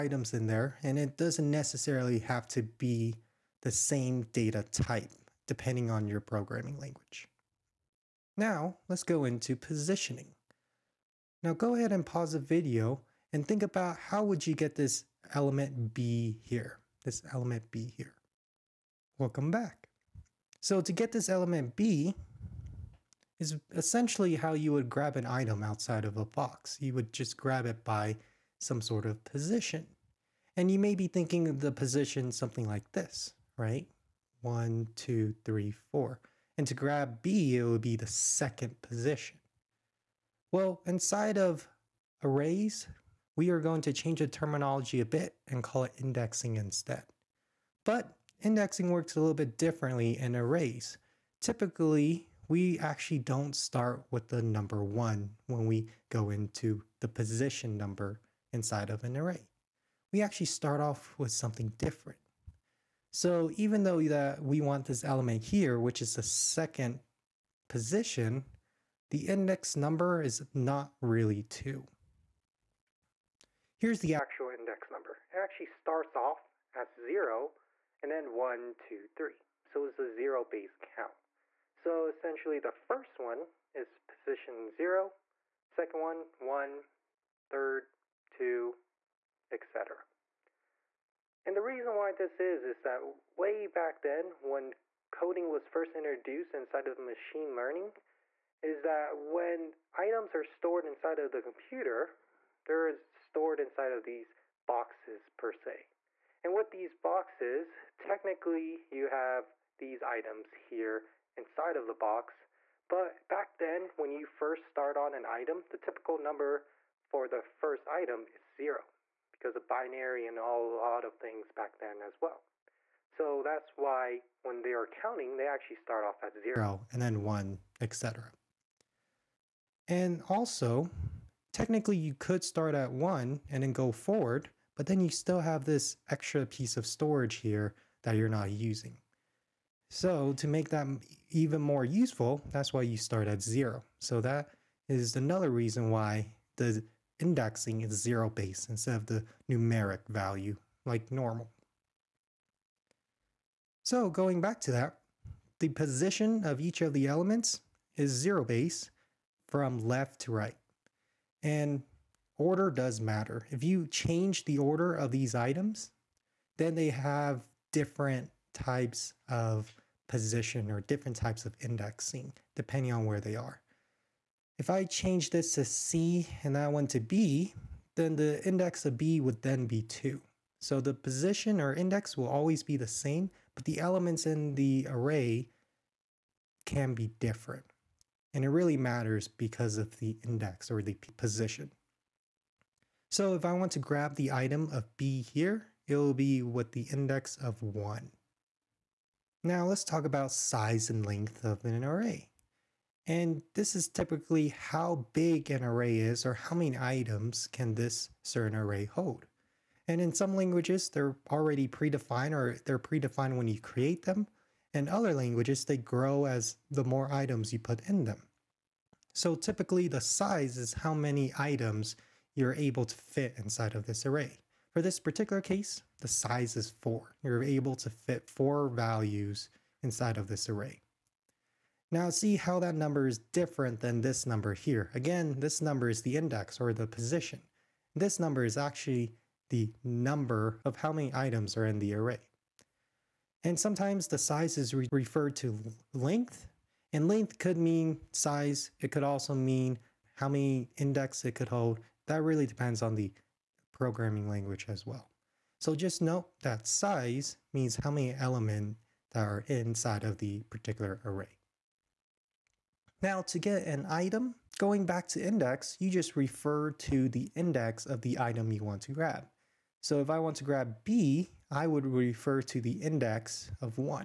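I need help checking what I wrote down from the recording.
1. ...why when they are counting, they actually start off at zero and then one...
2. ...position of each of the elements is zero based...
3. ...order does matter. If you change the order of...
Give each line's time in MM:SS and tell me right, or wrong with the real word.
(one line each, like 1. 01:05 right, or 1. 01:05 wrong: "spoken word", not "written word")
1. 02:03 right
2. 02:35 right
3. 02:42 right.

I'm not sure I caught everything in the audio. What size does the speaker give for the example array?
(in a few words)
4.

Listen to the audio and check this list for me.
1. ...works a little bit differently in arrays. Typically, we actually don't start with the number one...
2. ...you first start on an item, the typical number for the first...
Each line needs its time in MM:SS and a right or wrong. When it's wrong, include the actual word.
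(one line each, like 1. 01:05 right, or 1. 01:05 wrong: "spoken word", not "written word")
1. 00:48 right
2. 01:54 right.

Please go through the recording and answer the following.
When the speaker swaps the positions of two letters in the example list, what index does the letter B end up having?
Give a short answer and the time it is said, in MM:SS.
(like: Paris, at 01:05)
2, at 02:57.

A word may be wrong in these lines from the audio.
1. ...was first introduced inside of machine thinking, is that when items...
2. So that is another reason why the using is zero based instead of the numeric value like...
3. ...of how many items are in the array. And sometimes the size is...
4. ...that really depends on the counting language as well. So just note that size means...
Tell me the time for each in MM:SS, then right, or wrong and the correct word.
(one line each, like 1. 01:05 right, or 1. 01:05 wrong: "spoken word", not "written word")
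1. 01:35 wrong: "learning", not "thinking"
2. 02:23 wrong: "indexing", not "using"
3. 04:00 right
4. 04:12 wrong: "programming", not "counting".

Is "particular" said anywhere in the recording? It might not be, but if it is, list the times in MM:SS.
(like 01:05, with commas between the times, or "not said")
03:44, 04:20.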